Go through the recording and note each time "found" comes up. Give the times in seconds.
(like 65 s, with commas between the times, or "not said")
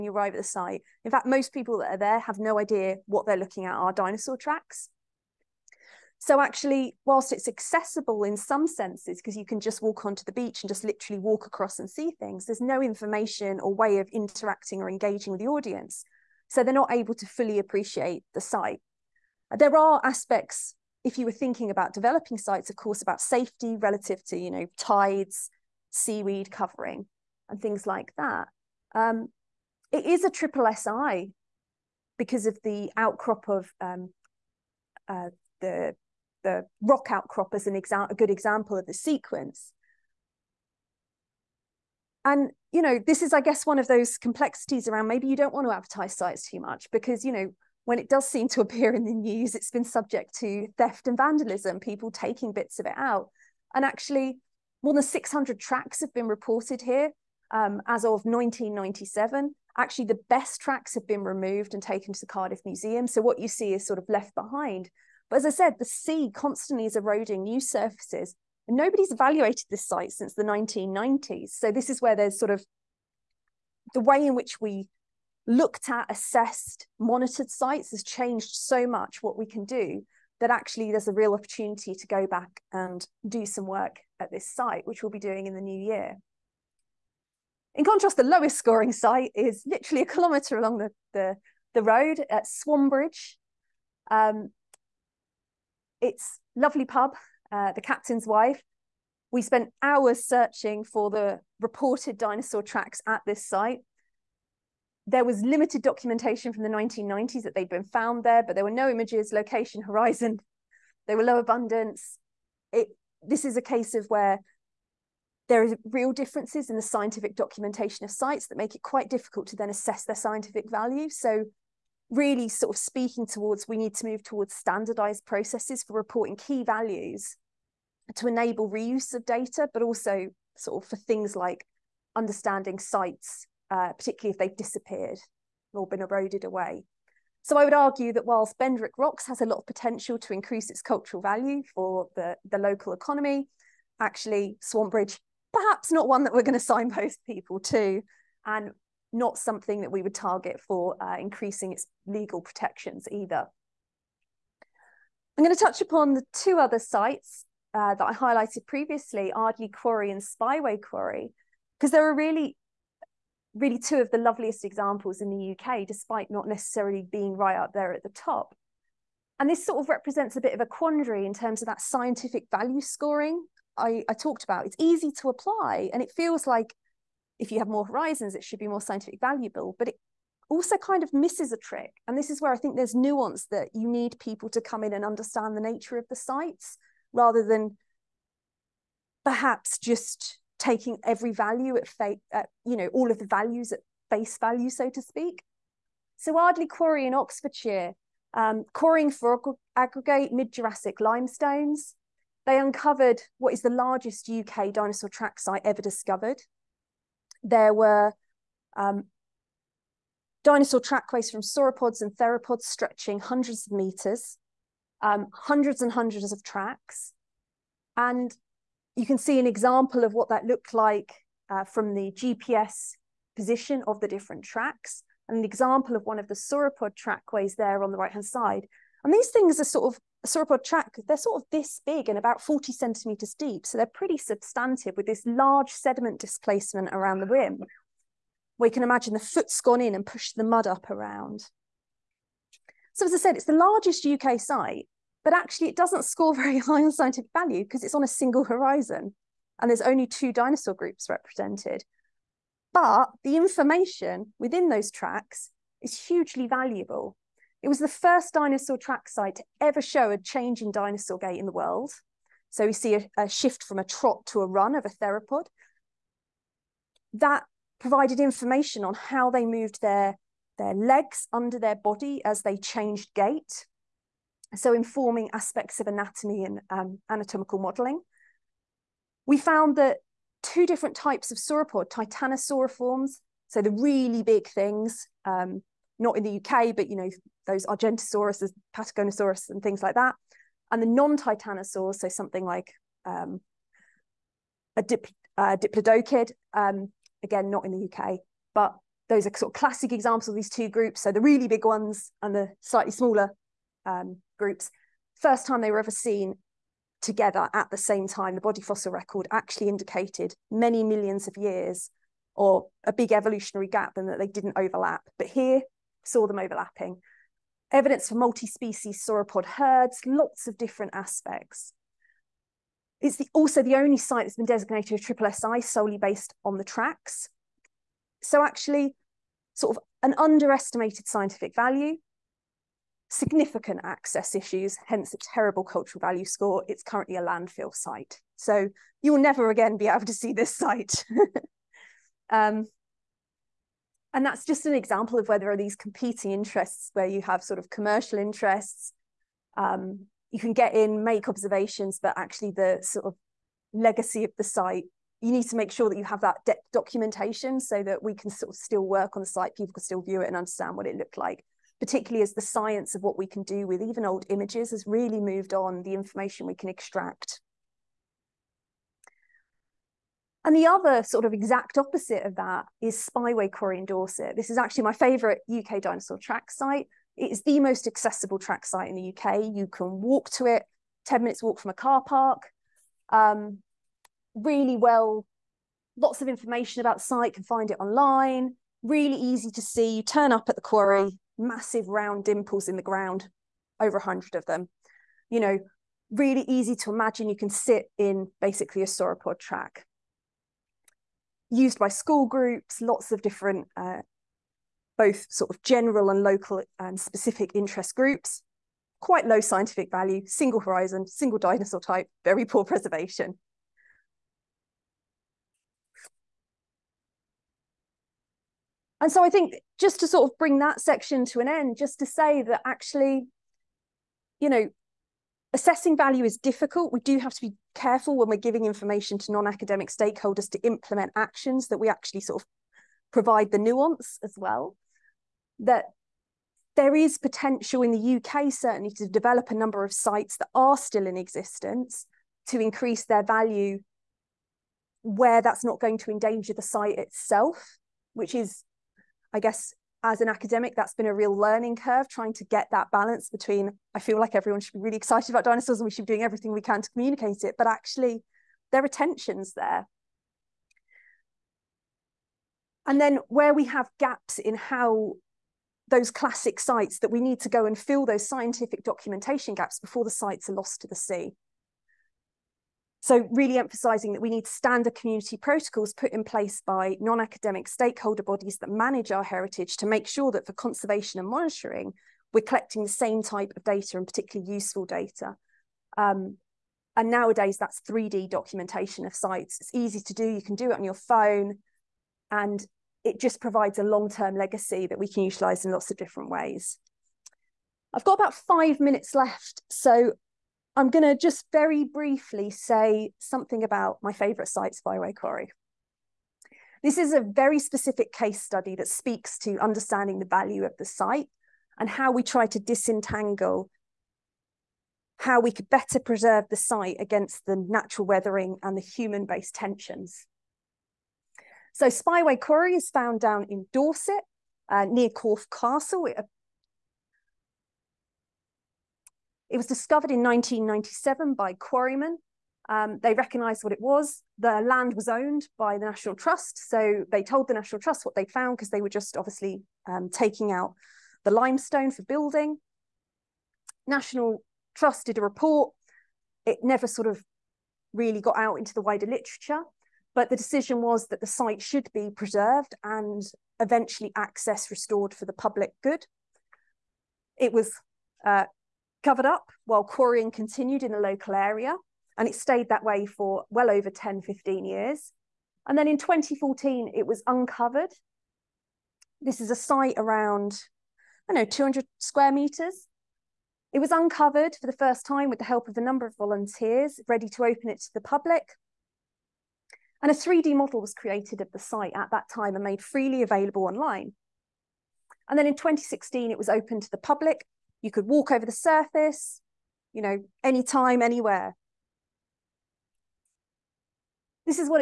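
107 s, 279 s, 522 s, 538 s.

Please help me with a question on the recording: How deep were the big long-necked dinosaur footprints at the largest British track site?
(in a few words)
about 40 centimetres.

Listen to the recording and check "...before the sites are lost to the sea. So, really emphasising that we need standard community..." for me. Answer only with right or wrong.
right.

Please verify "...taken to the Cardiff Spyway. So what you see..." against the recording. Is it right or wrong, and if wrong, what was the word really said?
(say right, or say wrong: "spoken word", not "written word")
wrong: "Museum", not "Spyway".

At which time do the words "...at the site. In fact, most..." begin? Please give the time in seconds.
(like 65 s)
0 s.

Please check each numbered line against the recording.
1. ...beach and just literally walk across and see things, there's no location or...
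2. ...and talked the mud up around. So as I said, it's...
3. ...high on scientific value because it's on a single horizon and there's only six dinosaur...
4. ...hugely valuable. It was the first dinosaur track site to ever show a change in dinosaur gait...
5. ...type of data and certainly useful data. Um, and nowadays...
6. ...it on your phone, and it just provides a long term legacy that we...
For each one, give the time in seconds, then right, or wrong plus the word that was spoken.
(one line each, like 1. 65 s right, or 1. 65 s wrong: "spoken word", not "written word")
1. 10 s wrong: "information", not "location"
2. 239 s wrong: "pushed", not "talked"
3. 246 s wrong: "two", not "six"
4. 255 s right
5. 483 s wrong: "particularly", not "certainly"
6. 490 s right.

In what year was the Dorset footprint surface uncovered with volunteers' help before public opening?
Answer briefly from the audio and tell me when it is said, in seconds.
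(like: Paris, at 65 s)
2014, at 565 s.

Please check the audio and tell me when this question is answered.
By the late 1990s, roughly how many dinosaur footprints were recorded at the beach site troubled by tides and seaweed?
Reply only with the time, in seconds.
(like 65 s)
54 s.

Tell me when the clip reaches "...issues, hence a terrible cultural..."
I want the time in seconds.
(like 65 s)
334 s.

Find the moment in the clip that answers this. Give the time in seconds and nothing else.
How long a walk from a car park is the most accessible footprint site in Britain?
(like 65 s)
381 s.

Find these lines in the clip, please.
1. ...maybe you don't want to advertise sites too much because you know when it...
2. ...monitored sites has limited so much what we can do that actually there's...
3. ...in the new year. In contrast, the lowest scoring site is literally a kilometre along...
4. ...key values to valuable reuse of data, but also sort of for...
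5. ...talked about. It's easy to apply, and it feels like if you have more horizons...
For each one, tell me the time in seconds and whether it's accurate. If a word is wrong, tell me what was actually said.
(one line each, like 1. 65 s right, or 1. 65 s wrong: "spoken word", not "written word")
1. 45 s right
2. 76 s wrong: "changed", not "limited"
3. 85 s right
4. 126 s wrong: "enable", not "valuable"
5. 174 s right.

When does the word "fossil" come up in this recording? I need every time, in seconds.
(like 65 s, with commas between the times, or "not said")
308 s.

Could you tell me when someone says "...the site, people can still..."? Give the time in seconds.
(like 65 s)
359 s.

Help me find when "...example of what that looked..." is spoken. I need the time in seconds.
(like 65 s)
219 s.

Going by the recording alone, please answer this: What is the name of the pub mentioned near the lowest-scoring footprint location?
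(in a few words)
The Captain's Wife.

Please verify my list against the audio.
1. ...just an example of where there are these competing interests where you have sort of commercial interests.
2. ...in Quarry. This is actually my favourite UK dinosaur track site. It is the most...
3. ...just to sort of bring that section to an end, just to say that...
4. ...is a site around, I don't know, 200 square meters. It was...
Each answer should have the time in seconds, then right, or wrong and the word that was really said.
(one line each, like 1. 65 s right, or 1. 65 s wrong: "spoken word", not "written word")
1. 344 s right
2. 373 s wrong: "Dorset", not "Quarry"
3. 419 s right
4. 569 s right.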